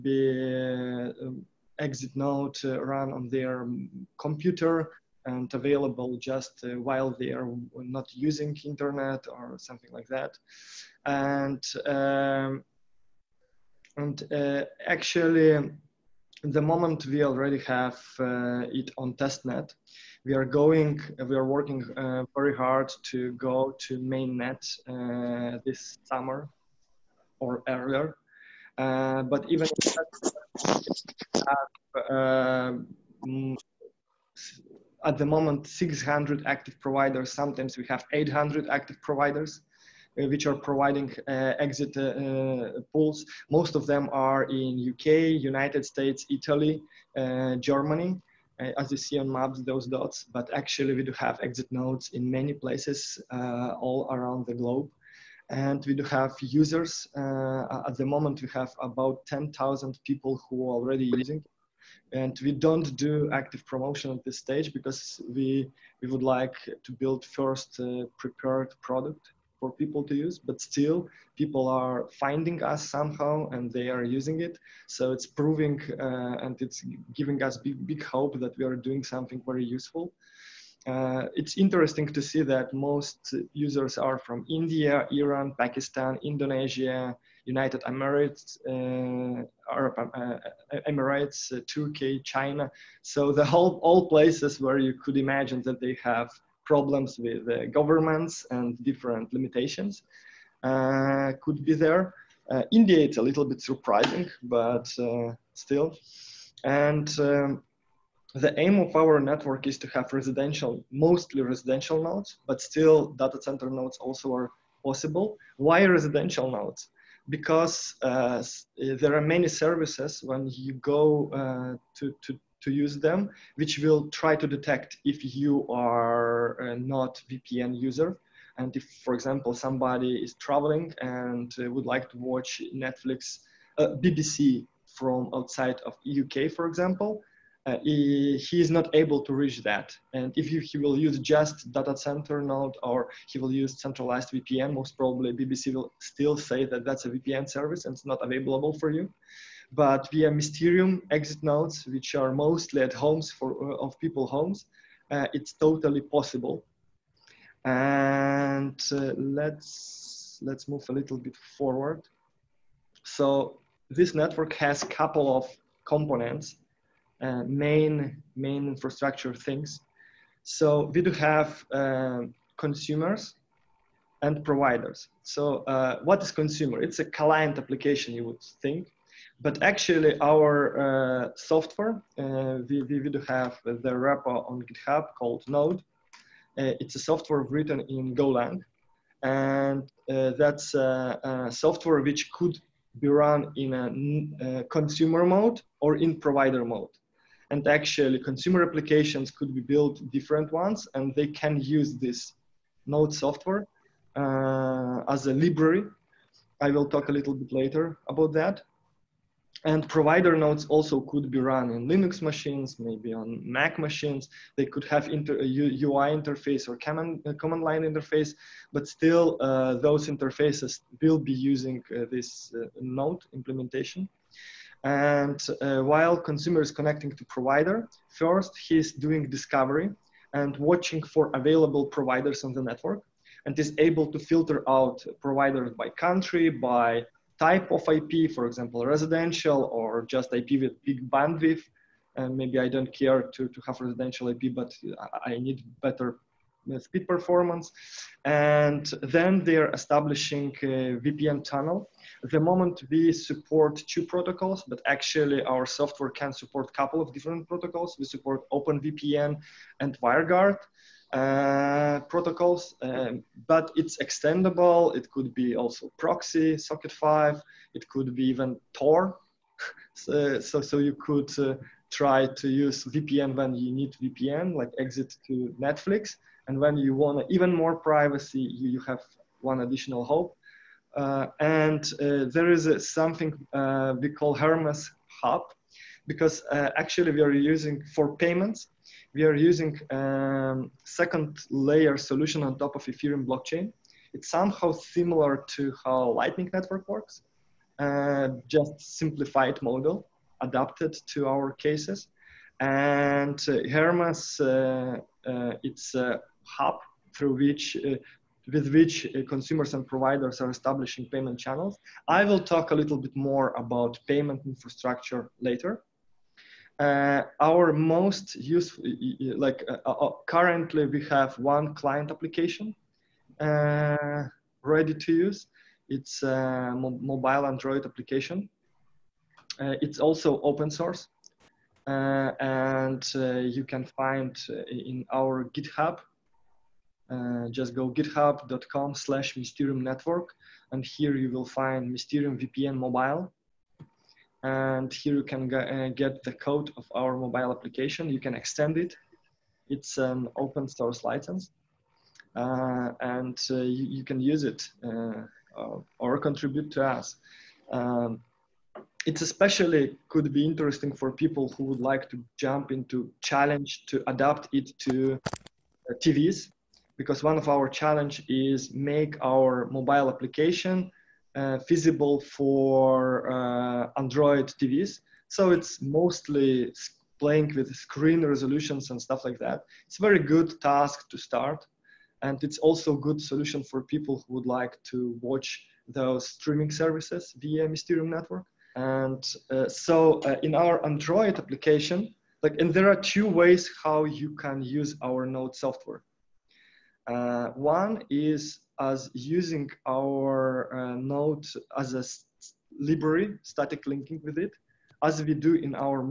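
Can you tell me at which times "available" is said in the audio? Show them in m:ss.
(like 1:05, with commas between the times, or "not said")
0:05, 2:28, 3:51.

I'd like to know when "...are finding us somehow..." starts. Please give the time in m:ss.
1:11.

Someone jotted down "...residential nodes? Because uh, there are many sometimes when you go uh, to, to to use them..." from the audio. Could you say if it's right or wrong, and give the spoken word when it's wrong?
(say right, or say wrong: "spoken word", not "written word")
wrong: "services", not "sometimes".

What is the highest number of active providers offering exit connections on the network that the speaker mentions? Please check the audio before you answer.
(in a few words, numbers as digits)
800.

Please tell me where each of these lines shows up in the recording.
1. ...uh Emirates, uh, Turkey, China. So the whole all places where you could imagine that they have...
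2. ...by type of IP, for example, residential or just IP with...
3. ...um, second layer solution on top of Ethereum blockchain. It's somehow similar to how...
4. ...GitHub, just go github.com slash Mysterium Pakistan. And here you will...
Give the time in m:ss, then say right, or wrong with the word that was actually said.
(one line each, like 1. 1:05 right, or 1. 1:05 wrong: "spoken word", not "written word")
1. 1:30 right
2. 3:56 right
3. 4:49 right
4. 5:35 wrong: "Network", not "Pakistan".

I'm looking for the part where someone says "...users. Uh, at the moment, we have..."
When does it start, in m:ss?
0:56.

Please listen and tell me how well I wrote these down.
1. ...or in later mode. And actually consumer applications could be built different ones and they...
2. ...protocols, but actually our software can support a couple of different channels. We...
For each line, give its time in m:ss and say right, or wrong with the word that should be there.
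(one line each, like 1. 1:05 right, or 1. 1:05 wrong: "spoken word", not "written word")
1. 3:15 wrong: "provider", not "later"
2. 4:14 wrong: "protocols", not "channels".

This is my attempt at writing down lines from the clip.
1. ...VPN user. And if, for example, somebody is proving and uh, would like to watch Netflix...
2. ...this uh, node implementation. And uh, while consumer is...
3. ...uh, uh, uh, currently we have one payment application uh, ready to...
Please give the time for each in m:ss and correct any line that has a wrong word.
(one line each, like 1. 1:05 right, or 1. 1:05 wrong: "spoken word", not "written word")
1. 2:07 wrong: "traveling", not "proving"
2. 3:42 right
3. 5:19 wrong: "client", not "payment".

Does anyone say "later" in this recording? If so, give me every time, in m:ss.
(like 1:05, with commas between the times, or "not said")
3:27, 5:15.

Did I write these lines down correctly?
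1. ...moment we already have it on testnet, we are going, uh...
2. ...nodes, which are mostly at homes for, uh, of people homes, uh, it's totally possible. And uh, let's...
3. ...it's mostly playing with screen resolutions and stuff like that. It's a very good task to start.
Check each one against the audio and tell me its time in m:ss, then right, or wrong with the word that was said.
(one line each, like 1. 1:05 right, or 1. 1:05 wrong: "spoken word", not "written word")
1. 0:16 right
2. 2:31 right
3. 6:15 right.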